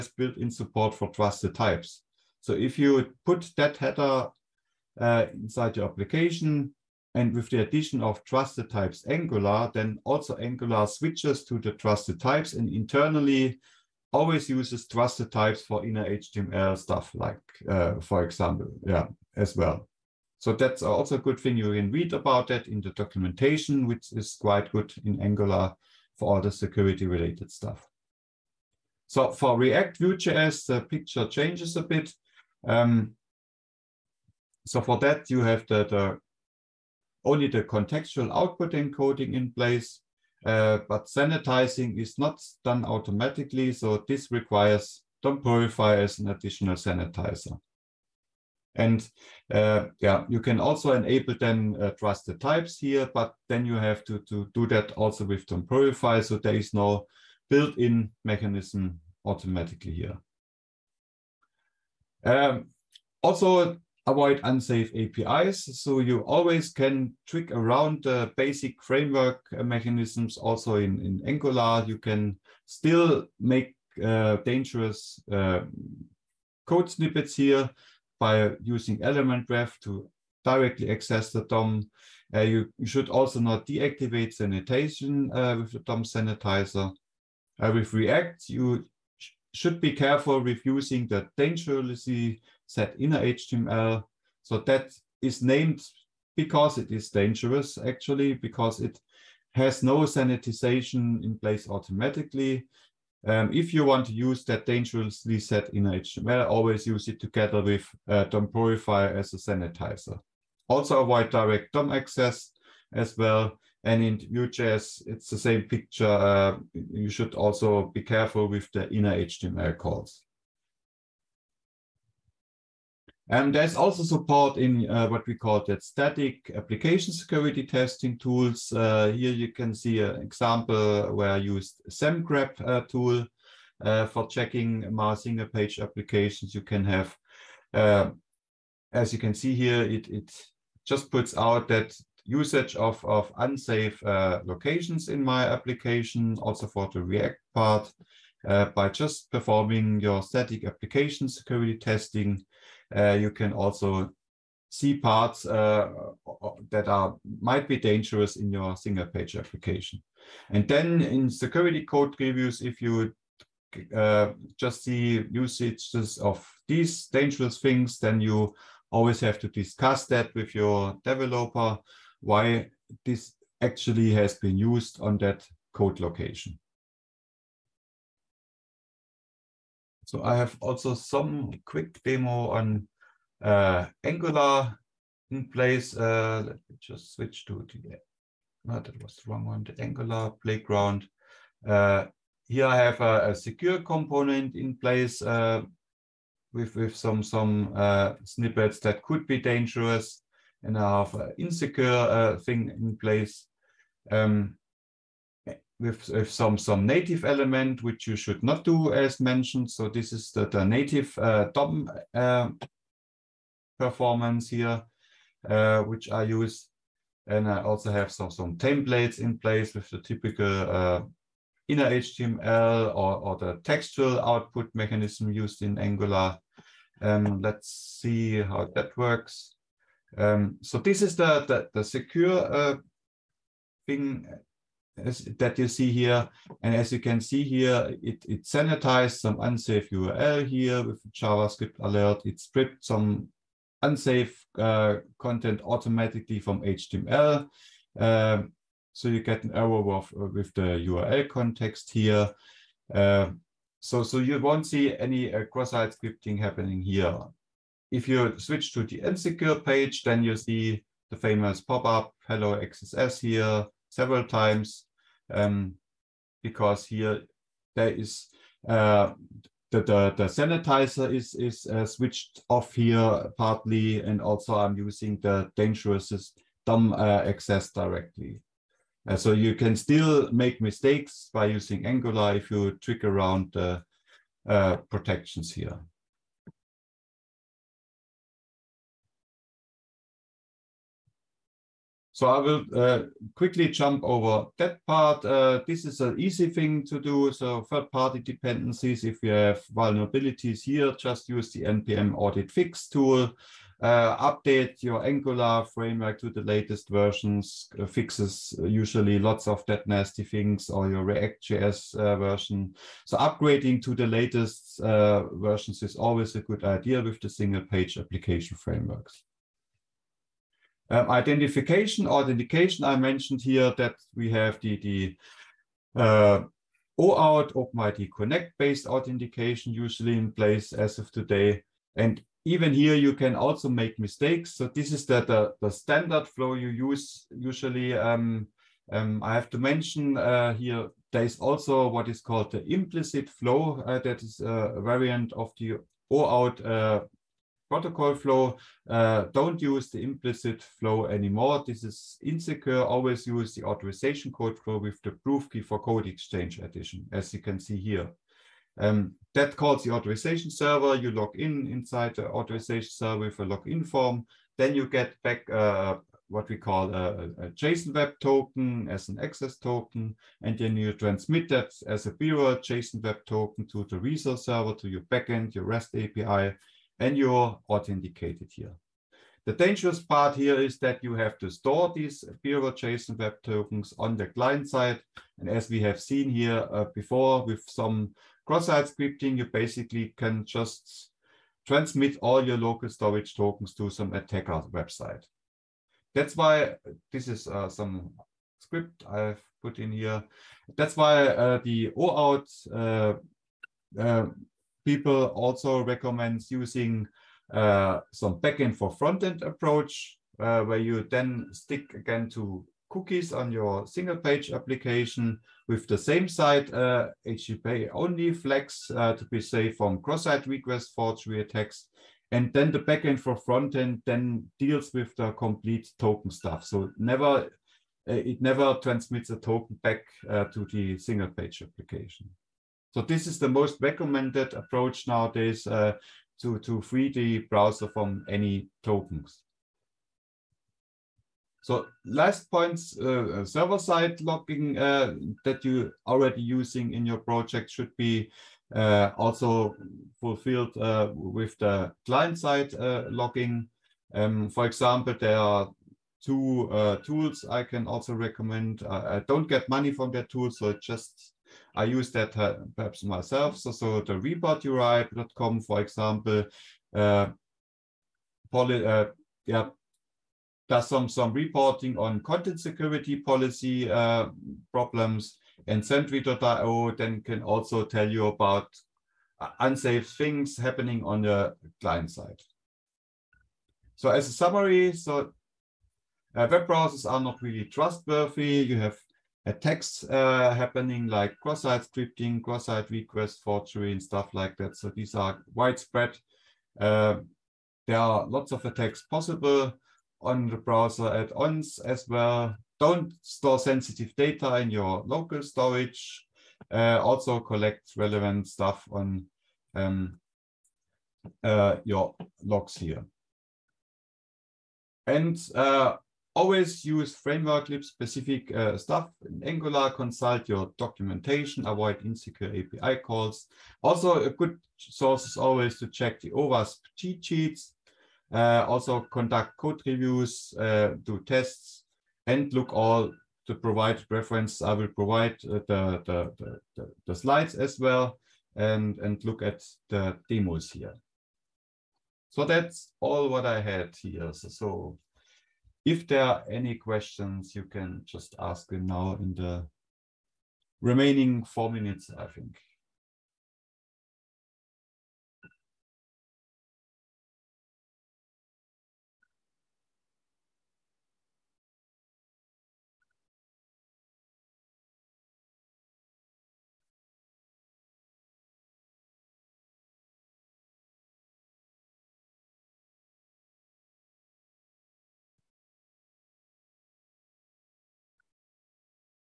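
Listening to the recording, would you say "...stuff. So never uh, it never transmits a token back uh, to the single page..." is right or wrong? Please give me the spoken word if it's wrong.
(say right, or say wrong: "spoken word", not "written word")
right.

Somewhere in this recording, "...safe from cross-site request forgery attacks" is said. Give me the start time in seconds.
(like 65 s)
419 s.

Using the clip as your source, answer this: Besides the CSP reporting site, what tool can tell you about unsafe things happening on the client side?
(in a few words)
Sentry.io.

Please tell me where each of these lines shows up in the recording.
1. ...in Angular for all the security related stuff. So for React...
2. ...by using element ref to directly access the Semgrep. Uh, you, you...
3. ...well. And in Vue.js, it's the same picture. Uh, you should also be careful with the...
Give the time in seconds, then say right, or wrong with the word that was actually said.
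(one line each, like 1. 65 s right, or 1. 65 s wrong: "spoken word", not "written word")
1. 25 s right
2. 78 s wrong: "DOM", not "Semgrep"
3. 113 s right.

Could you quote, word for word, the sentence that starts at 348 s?
Uh, don't use the implicit flow anymore.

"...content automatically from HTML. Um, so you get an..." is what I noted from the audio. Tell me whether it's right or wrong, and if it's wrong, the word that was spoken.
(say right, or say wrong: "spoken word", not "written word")
right.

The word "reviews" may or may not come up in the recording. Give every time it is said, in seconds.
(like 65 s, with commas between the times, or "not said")
162 s, 529 s.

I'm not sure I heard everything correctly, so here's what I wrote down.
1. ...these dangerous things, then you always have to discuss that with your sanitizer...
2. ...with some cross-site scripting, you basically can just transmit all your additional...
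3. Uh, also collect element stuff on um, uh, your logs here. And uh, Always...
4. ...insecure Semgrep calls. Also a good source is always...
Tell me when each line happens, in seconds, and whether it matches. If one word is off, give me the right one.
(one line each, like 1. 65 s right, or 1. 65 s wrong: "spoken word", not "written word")
1. 166 s wrong: "developer", not "sanitizer"
2. 387 s wrong: "local", not "additional"
3. 506 s wrong: "relevant", not "element"
4. 522 s wrong: "API", not "Semgrep".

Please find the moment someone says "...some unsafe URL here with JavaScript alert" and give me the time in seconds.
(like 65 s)
239 s.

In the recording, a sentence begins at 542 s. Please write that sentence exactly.
So that's all what I had here.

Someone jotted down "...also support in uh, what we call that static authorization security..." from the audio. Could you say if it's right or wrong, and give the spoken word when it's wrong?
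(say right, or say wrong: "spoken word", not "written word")
wrong: "application", not "authorization".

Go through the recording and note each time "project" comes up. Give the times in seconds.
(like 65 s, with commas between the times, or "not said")
447 s.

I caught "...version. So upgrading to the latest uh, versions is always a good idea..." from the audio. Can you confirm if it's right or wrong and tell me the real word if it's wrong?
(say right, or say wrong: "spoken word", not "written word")
right.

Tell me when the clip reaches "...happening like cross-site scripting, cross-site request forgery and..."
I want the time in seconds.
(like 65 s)
490 s.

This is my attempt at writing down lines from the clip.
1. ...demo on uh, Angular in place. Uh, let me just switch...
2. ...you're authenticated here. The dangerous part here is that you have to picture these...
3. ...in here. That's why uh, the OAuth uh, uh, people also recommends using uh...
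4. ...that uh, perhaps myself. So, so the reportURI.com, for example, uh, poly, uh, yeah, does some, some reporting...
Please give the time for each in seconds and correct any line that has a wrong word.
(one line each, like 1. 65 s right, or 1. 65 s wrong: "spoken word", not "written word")
1. 182 s right
2. 377 s wrong: "store", not "picture"
3. 399 s right
4. 462 s right.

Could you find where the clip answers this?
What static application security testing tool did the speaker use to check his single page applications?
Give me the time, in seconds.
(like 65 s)
131 s.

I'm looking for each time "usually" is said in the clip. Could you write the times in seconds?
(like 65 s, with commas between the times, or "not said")
308 s, 329 s, 337 s.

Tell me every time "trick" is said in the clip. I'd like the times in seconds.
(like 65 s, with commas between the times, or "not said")
67 s, 282 s.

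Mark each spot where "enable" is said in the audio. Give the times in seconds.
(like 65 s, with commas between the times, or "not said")
50 s.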